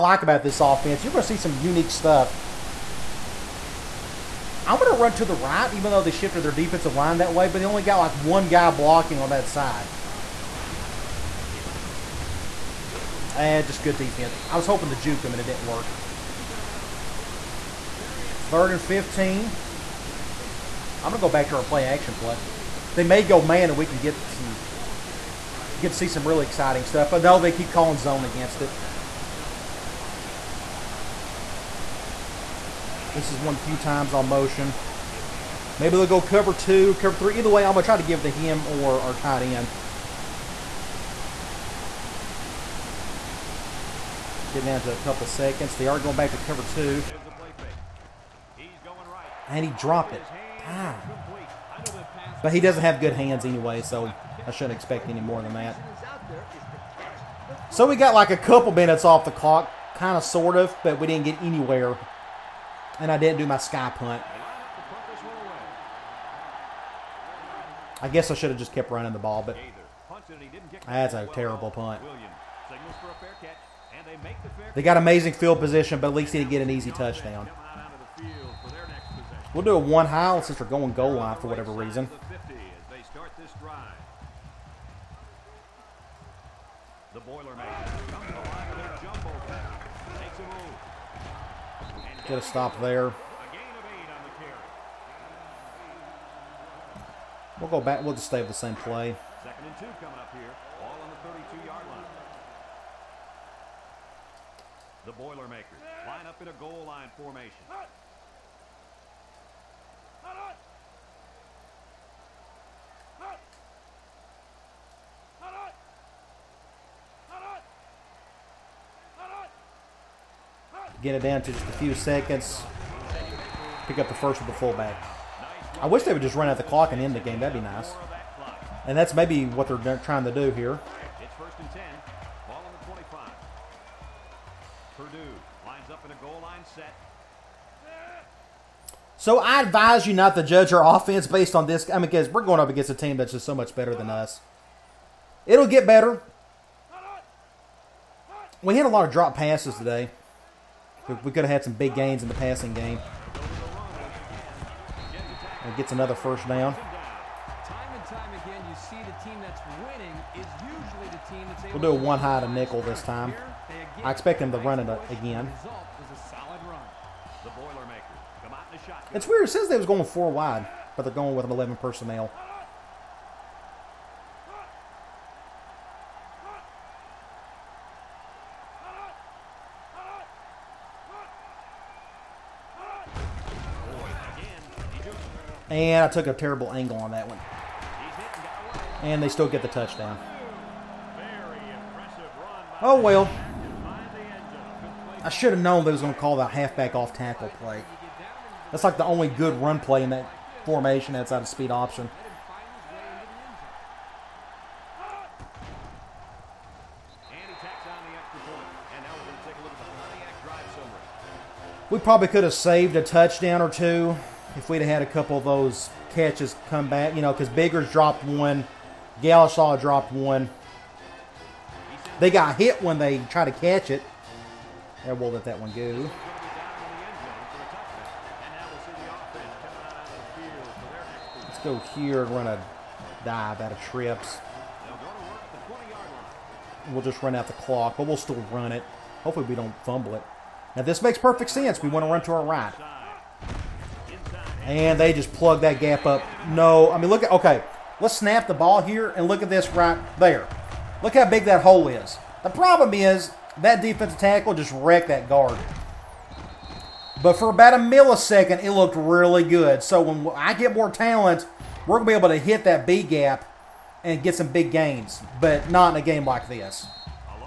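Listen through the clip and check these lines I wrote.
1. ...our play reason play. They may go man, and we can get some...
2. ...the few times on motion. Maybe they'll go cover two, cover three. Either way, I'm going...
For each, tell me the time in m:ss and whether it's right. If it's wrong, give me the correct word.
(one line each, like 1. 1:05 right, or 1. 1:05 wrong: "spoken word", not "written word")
1. 0:21 wrong: "action", not "reason"
2. 0:33 right.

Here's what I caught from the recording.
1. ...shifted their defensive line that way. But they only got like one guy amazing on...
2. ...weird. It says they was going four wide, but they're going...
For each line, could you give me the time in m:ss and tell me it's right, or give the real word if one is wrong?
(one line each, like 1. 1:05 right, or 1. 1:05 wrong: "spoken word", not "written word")
1. 0:06 wrong: "blocking", not "amazing"
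2. 2:49 right.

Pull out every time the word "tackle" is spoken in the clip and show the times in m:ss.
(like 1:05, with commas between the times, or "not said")
3:17, 4:14.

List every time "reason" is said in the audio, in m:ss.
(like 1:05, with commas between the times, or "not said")
1:21.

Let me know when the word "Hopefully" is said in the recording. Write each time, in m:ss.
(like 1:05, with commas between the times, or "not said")
3:59.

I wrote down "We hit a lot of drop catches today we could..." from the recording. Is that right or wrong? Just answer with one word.
wrong.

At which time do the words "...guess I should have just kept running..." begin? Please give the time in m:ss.
1:08.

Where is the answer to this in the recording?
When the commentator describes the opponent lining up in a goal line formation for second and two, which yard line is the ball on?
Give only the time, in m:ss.
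1:41.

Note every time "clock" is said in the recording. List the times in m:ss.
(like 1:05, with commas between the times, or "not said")
0:59, 2:06, 3:57.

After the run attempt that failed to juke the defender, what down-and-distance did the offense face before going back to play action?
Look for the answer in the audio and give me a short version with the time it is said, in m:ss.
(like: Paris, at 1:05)
Third and 15, at 0:18.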